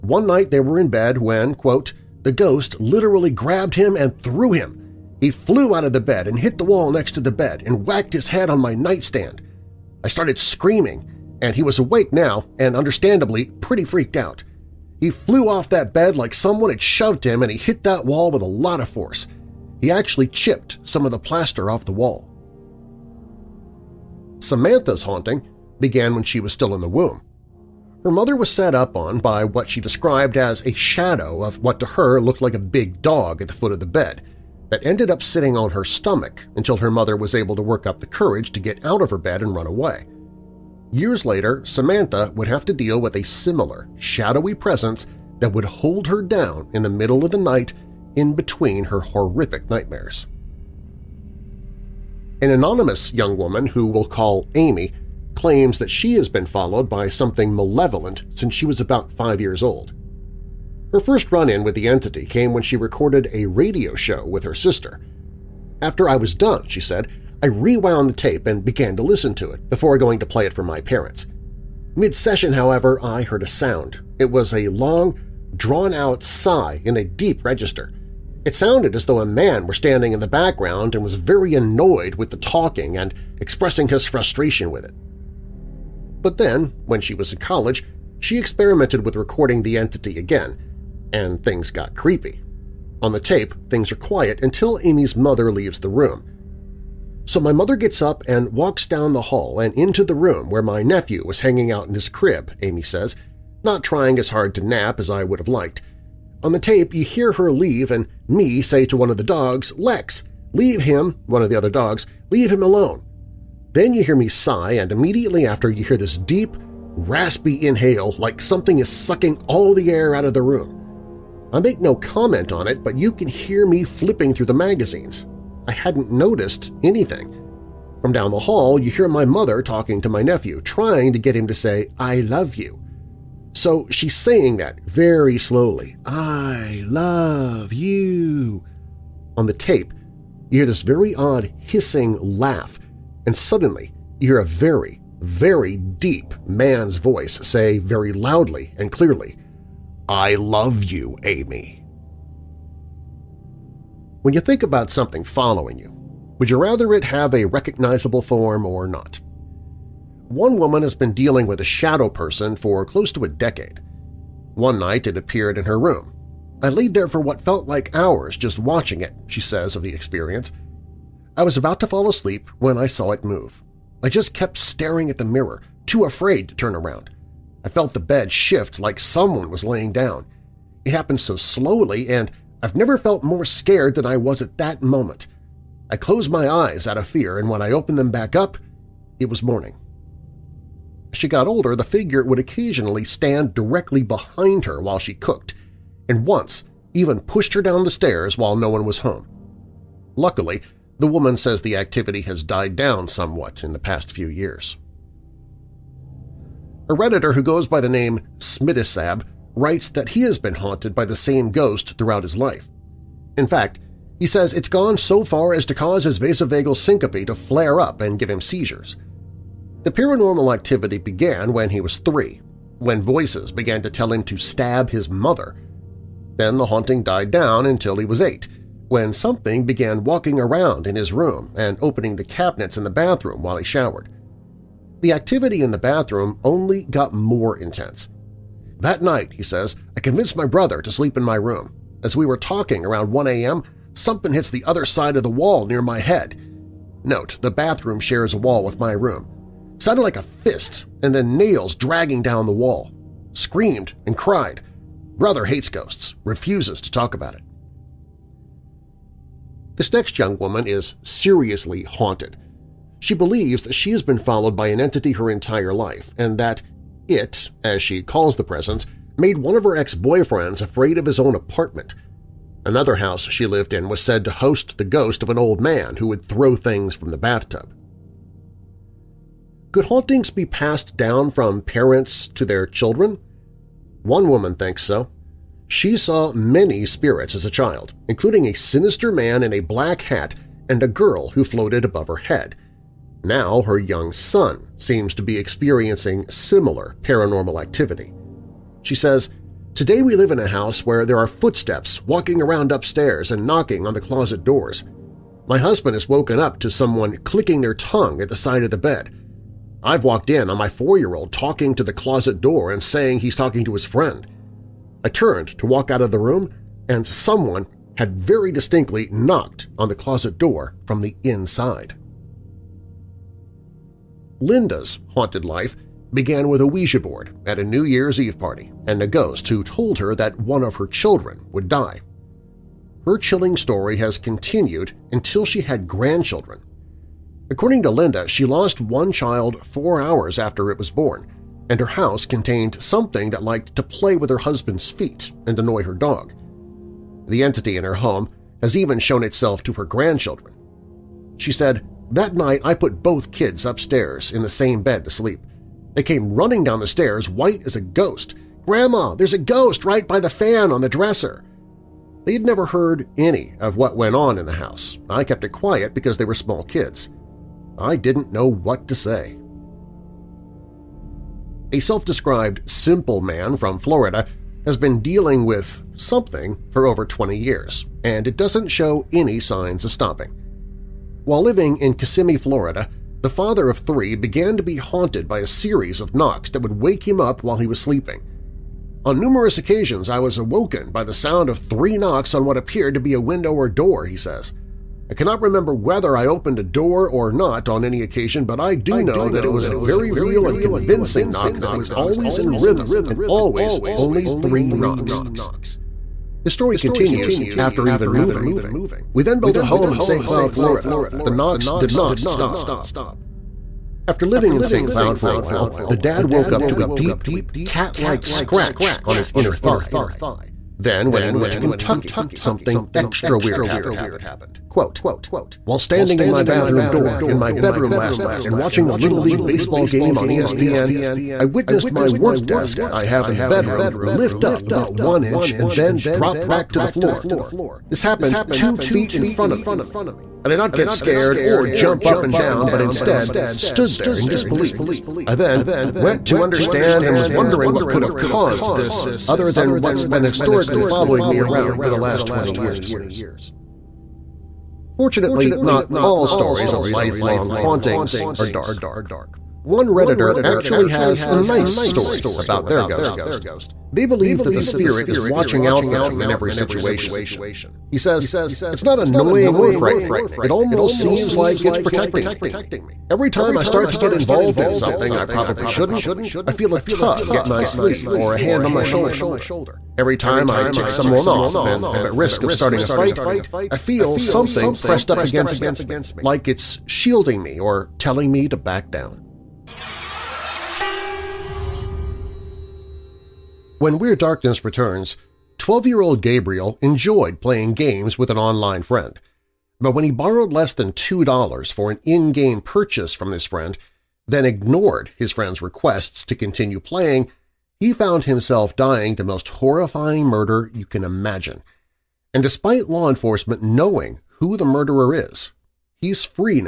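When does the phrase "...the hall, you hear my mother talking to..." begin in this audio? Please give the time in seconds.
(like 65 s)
128 s.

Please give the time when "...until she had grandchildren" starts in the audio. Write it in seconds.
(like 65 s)
335 s.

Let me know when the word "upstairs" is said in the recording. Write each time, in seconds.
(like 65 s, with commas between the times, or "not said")
302 s, 353 s.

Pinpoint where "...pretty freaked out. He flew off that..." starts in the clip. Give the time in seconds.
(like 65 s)
13 s.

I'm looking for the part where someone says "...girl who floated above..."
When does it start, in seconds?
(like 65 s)
290 s.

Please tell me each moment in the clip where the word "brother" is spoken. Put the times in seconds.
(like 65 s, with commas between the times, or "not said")
240 s, 255 s.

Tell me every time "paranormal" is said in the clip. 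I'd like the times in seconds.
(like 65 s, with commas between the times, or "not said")
219 s, 297 s.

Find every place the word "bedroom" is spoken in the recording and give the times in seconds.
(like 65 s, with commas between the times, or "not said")
427 s, 433 s.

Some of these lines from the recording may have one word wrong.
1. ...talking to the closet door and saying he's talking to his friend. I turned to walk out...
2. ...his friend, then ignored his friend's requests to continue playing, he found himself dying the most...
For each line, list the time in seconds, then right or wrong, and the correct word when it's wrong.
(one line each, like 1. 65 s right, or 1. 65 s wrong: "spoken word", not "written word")
1. 311 s right
2. 503 s right.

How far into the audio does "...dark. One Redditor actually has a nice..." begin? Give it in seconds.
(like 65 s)
458 s.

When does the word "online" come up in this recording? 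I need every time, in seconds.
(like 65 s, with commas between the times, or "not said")
498 s.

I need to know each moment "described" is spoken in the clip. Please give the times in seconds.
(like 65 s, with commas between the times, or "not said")
29 s, 371 s.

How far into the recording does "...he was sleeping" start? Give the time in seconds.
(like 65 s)
387 s.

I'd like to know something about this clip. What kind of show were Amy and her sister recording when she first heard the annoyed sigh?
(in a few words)
radio show.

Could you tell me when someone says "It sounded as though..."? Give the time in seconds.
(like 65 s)
78 s.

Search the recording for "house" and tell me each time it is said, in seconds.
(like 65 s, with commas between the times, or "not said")
272 s, 300 s, 341 s, 364 s.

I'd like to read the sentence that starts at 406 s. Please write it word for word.
The story continues after even moving.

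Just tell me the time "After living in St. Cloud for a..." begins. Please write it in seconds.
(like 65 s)
414 s.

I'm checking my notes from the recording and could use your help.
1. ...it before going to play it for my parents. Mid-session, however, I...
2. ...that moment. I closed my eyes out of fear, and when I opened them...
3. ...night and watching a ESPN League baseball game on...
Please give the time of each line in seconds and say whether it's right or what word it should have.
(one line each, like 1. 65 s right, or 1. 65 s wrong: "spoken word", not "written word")
1. 69 s right
2. 184 s right
3. 428 s wrong: "Little", not "ESPN".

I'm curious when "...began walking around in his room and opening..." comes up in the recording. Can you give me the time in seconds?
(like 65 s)
229 s.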